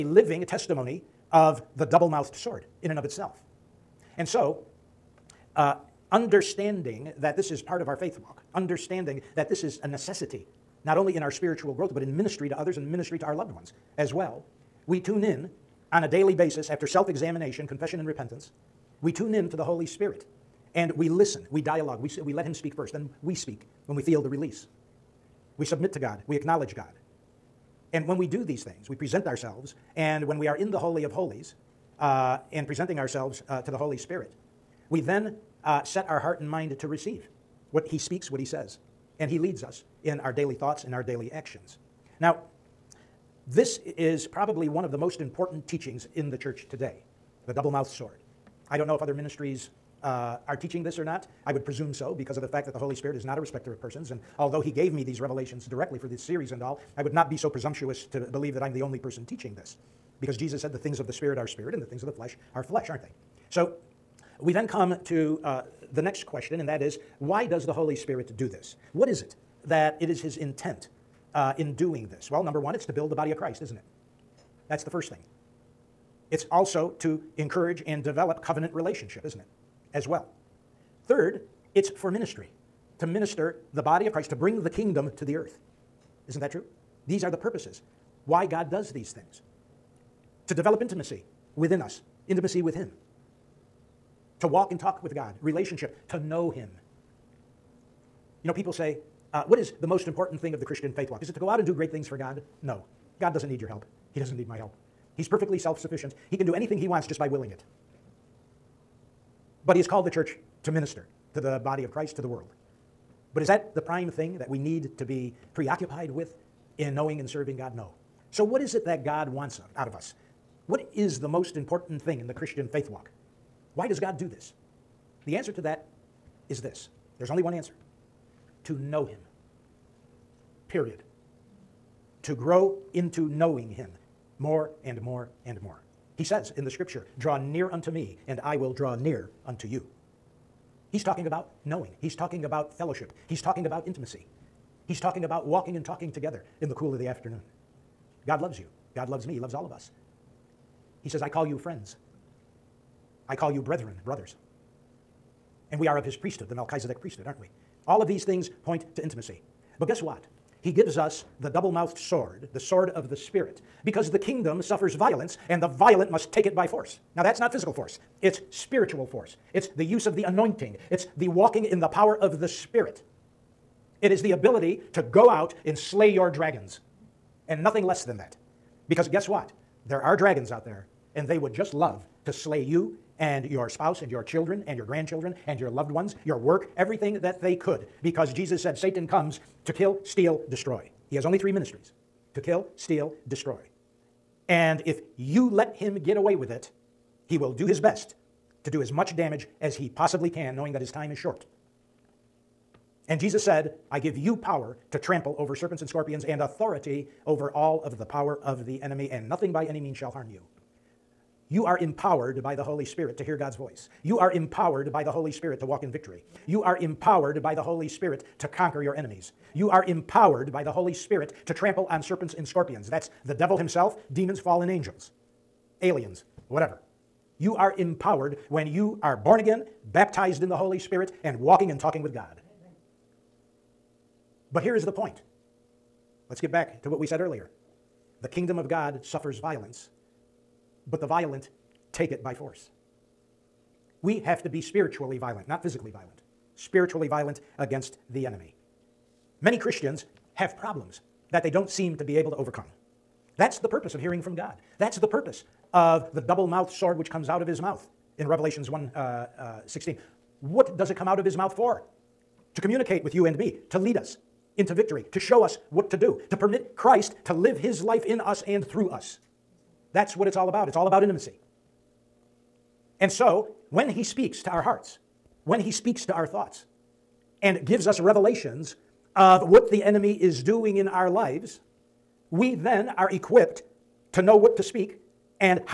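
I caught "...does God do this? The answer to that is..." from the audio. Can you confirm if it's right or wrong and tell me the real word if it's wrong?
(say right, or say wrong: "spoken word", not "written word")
right.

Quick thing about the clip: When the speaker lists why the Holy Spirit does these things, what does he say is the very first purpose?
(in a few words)
To build the body of Christ.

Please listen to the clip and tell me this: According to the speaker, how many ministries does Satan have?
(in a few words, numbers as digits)
3.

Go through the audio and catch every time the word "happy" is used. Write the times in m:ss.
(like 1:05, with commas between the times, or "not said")
not said.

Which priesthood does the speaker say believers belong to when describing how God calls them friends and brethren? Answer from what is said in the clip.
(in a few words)
Melchizedek priesthood.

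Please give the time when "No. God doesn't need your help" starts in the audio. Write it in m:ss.
1:42.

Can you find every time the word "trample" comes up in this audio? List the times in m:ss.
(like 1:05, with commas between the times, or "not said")
3:24, 3:41.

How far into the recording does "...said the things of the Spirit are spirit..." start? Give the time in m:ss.
1:00.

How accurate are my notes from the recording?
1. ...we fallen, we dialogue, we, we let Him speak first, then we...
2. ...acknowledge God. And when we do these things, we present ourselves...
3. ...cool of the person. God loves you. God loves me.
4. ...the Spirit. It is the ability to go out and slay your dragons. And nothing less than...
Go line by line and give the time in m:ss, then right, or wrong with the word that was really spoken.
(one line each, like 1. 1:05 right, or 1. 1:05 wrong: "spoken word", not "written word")
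1. 0:20 wrong: "listen", not "fallen"
2. 0:26 right
3. 2:26 wrong: "afternoon", not "person"
4. 2:52 right.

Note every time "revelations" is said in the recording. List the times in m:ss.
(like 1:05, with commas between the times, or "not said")
0:55, 4:18, 4:37.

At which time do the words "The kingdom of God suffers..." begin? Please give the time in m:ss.
3:58.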